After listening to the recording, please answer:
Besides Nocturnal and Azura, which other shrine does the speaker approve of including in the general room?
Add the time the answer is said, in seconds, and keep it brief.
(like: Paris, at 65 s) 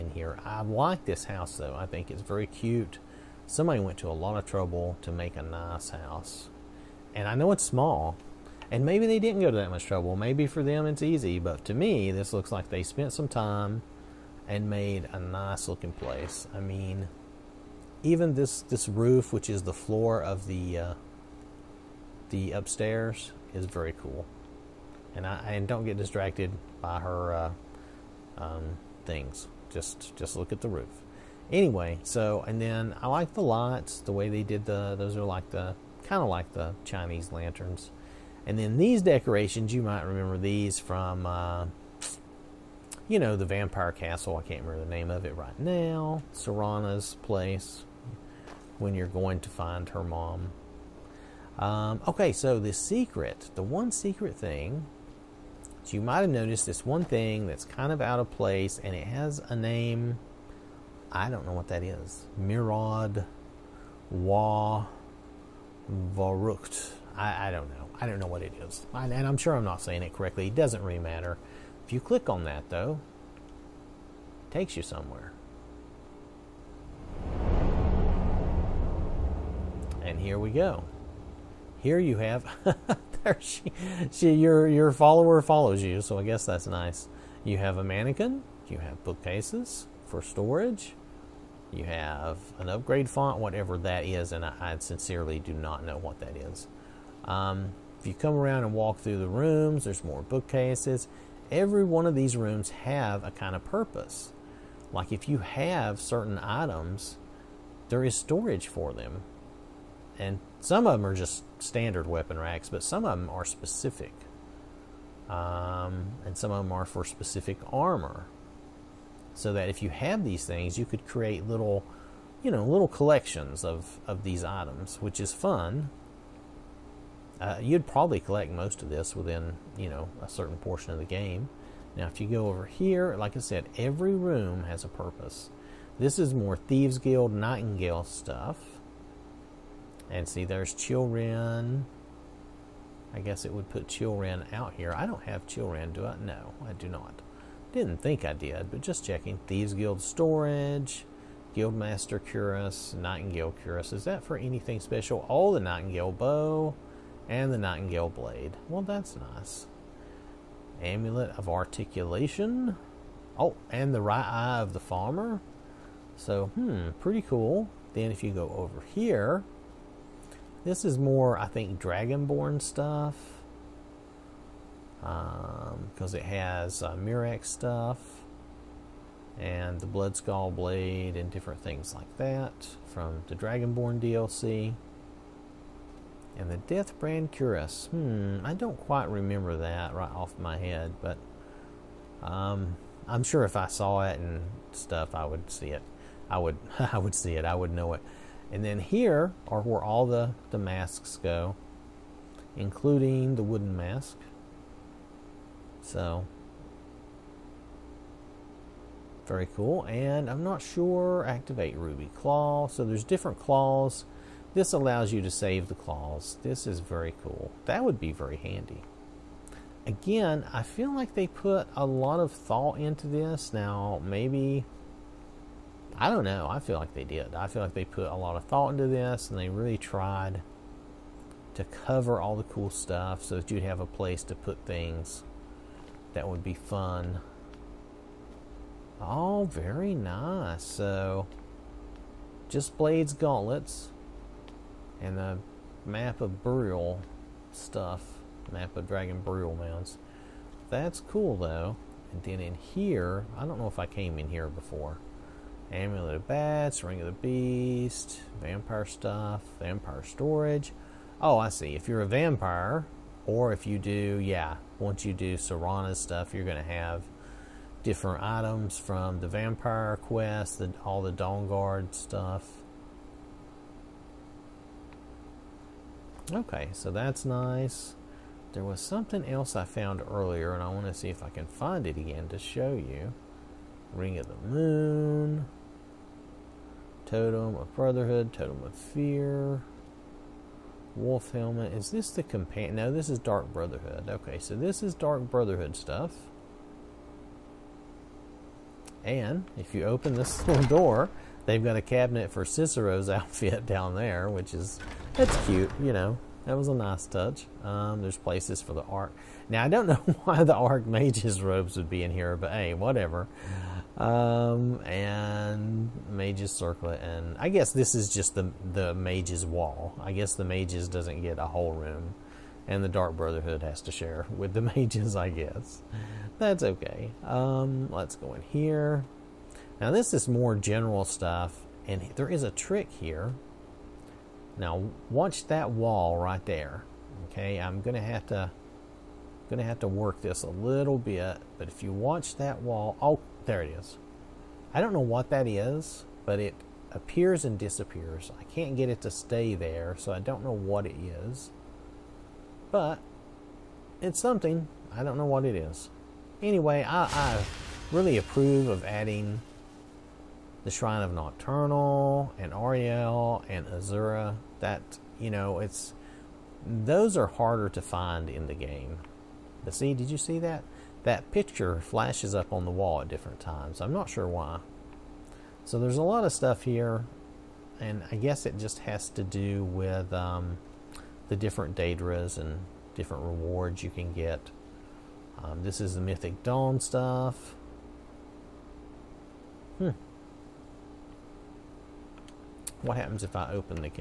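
Ariel, at 362 s.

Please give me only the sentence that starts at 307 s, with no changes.
Um, there's places for the Ark.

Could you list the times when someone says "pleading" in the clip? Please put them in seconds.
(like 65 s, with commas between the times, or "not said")
not said.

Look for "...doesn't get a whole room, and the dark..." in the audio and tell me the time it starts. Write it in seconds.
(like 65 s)
320 s.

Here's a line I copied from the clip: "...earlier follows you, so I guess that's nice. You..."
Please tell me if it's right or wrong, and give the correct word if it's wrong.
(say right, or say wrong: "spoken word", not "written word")
wrong: "follower", not "earlier".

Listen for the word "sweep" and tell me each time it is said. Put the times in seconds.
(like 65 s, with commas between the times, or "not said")
not said.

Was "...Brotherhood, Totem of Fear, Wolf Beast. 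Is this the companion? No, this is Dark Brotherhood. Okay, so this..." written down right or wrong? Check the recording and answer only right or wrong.
wrong.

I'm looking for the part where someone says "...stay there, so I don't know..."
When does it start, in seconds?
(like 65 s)
349 s.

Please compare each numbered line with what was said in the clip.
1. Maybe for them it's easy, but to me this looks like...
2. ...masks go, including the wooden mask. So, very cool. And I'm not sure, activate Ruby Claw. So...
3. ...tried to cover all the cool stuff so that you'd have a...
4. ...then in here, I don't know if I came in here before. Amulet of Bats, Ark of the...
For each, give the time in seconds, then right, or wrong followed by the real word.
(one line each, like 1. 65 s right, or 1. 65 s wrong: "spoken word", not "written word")
1. 10 s right
2. 200 s right
3. 229 s right
4. 252 s wrong: "Ring", not "Ark".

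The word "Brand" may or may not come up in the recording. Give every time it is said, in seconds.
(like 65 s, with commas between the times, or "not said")
186 s.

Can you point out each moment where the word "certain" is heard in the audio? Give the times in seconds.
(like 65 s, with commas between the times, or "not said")
105 s, 130 s.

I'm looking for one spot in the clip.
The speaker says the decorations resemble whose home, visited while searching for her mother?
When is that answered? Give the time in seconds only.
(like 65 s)
46 s.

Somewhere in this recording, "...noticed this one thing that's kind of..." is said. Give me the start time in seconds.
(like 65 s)
56 s.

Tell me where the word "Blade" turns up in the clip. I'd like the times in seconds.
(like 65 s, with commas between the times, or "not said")
158 s, 180 s, 242 s.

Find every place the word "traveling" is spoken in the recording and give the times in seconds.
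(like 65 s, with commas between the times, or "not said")
not said.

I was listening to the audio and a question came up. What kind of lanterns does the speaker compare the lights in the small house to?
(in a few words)
Chinese lanterns.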